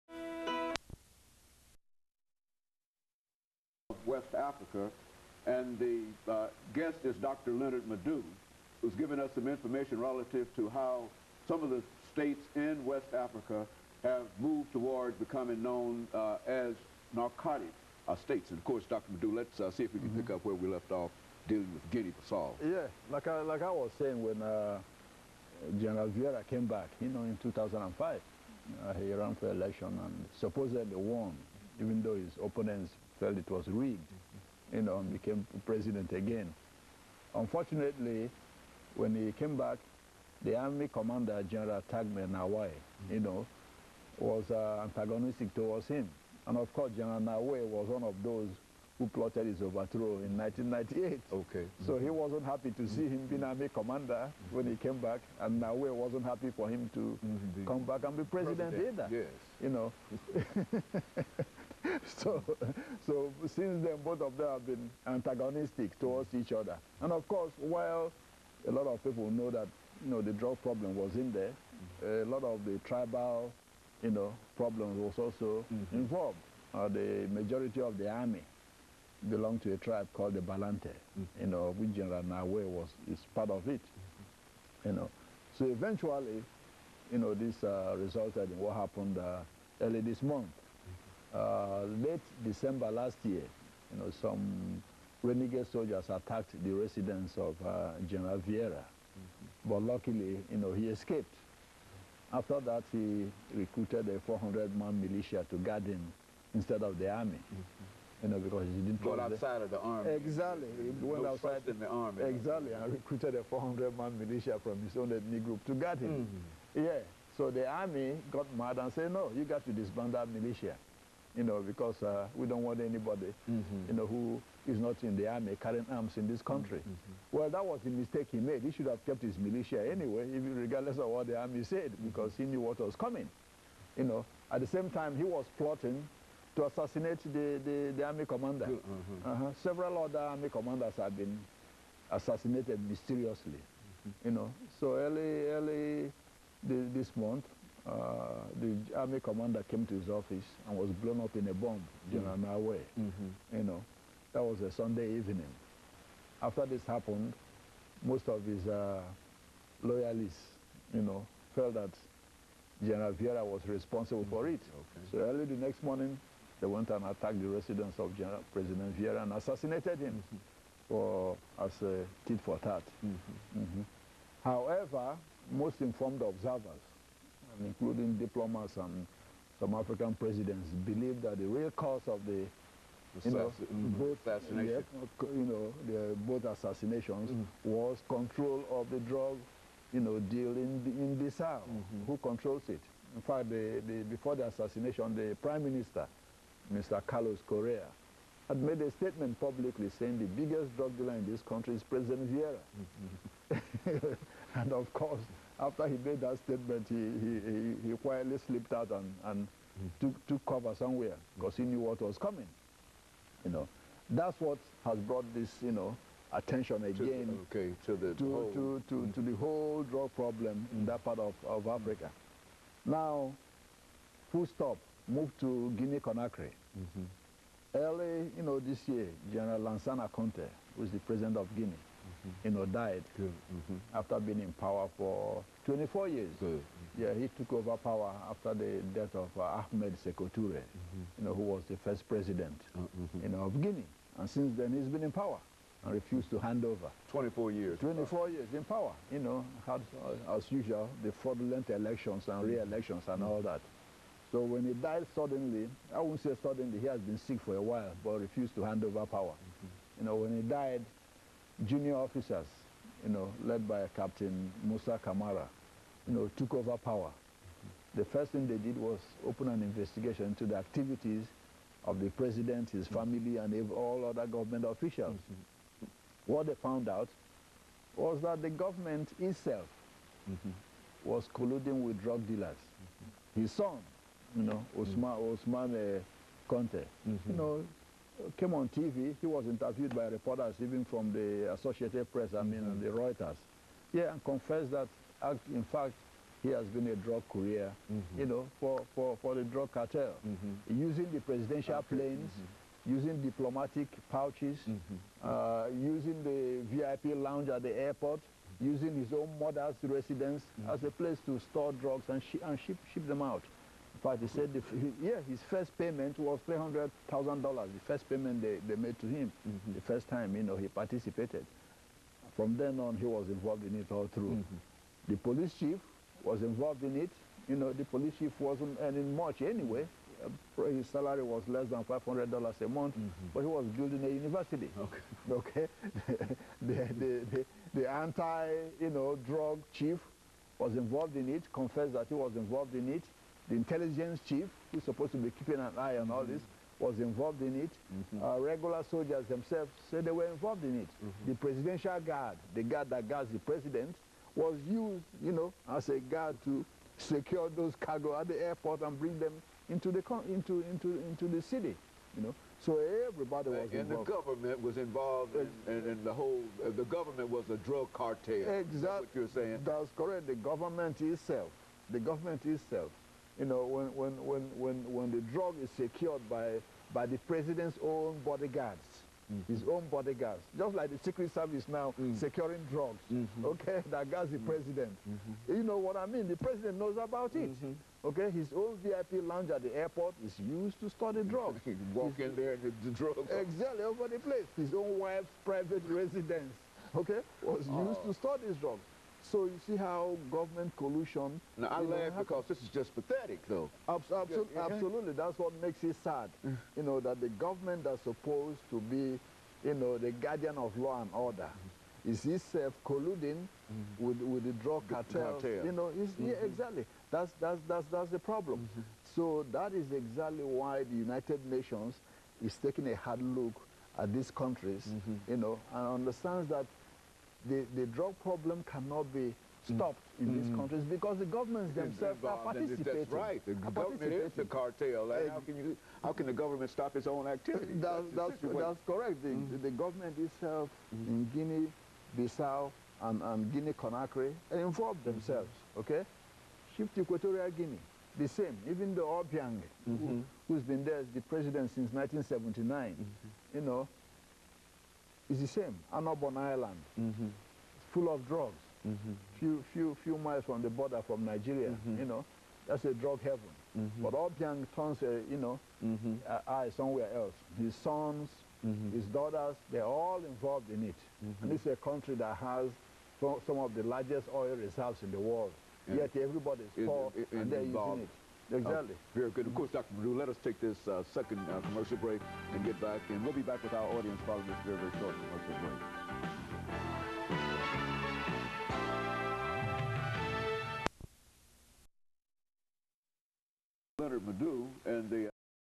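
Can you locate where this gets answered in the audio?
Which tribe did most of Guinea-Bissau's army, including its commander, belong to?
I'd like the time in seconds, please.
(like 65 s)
80 s.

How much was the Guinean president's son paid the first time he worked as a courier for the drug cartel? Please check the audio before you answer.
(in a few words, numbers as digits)
$300,000.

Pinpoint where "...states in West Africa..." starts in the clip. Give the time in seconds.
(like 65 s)
12 s.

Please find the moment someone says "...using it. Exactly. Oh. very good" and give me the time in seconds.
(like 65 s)
477 s.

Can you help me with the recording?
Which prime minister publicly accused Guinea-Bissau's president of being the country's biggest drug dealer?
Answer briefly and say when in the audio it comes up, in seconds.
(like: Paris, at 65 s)
Carlos Correia, at 197 s.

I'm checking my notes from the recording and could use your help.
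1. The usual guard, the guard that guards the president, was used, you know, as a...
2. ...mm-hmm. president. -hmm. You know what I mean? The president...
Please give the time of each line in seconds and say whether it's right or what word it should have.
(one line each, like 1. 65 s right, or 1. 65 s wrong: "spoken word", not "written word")
1. 351 s wrong: "presidential", not "usual"
2. 384 s right.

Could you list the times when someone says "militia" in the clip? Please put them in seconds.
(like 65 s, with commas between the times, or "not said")
104 s, 114 s, 120 s, 129 s.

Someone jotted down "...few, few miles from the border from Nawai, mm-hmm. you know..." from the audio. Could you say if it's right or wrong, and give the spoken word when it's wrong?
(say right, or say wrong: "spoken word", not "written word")
wrong: "Nigeria", not "Nawai".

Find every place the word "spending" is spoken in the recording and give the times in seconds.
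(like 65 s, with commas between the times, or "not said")
not said.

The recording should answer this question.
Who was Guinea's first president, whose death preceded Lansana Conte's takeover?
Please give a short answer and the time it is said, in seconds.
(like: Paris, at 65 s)
Ahmed Sekou Toure, at 239 s.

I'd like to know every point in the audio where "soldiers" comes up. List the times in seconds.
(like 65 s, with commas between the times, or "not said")
95 s, 348 s.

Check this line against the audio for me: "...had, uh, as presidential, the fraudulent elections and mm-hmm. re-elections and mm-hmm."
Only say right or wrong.
wrong.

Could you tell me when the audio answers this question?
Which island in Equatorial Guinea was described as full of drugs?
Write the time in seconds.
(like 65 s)
455 s.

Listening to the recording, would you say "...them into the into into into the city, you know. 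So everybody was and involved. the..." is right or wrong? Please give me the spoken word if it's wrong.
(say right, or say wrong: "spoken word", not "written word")
right.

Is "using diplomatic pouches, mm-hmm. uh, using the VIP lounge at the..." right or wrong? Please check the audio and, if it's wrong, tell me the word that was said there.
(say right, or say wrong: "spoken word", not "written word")
right.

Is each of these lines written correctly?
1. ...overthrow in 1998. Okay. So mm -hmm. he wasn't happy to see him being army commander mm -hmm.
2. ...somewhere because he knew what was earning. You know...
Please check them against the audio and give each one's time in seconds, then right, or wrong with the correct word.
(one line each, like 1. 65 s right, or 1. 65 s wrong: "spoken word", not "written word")
1. 49 s right
2. 210 s wrong: "coming", not "earning".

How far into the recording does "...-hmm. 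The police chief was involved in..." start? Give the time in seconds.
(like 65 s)
324 s.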